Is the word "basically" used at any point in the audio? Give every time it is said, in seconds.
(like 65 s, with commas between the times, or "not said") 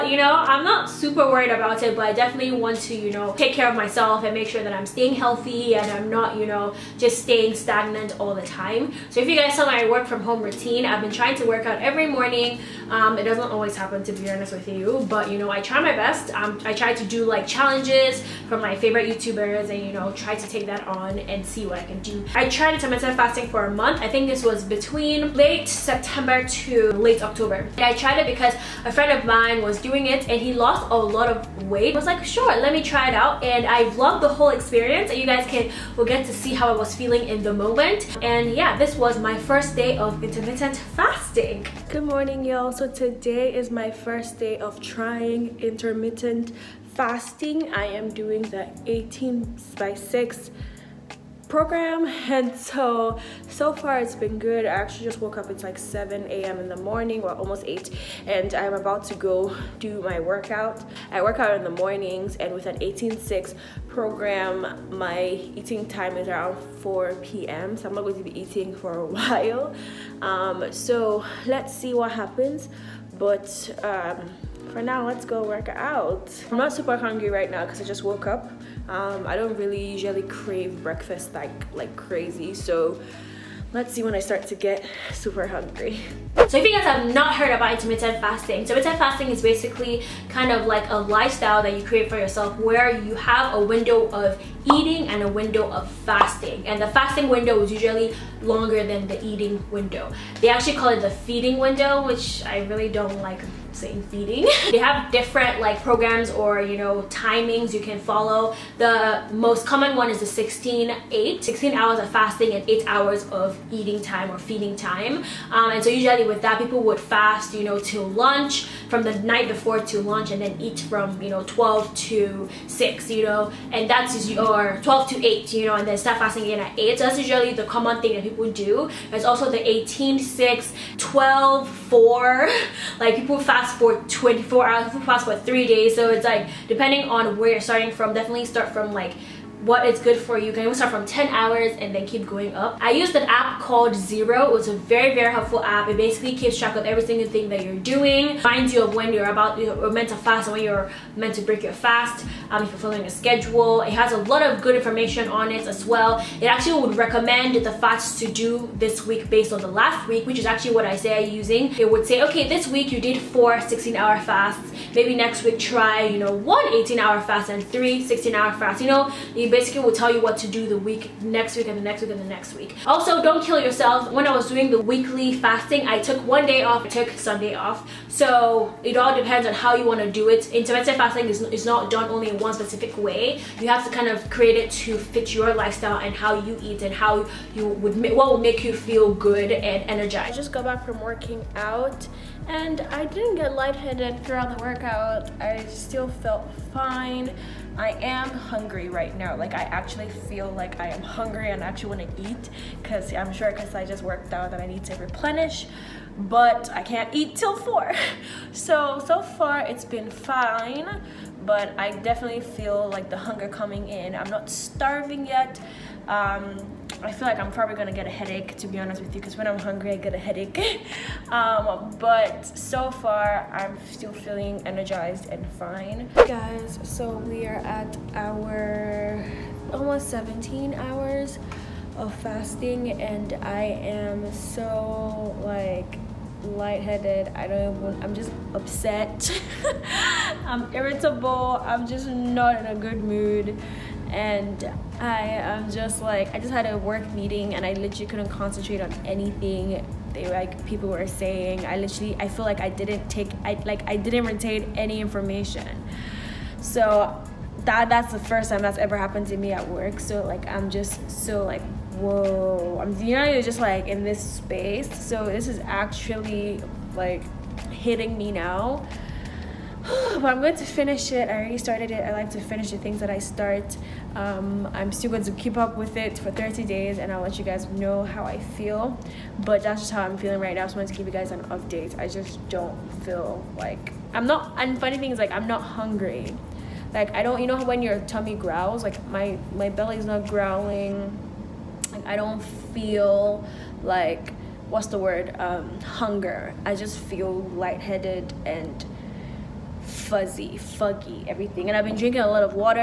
89 s, 145 s, 169 s.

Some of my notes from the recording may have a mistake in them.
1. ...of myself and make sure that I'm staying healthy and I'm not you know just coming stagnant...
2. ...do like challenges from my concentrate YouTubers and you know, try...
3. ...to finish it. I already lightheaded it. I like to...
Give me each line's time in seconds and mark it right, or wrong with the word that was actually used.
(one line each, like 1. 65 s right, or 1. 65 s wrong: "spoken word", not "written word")
1. 3 s wrong: "staying", not "coming"
2. 17 s wrong: "favorite", not "concentrate"
3. 270 s wrong: "started", not "lightheaded".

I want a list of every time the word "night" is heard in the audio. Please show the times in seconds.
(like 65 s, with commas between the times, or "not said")
119 s.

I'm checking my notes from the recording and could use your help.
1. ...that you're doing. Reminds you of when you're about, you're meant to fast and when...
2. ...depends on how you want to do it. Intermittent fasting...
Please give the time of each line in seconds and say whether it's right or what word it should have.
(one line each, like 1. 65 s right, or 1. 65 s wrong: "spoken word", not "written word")
1. 147 s right
2. 179 s right.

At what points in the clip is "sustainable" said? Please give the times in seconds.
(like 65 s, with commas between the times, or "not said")
not said.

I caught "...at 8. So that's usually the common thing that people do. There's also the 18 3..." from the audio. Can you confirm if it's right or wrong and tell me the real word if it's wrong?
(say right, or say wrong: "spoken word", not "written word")
wrong: "6", not "3".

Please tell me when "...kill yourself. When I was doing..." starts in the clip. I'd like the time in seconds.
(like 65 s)
173 s.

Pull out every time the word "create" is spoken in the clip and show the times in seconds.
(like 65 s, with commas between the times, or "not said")
91 s, 184 s.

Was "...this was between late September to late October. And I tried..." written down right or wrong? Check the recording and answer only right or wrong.
right.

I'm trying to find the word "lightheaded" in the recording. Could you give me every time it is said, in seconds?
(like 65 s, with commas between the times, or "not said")
193 s, 236 s, 297 s.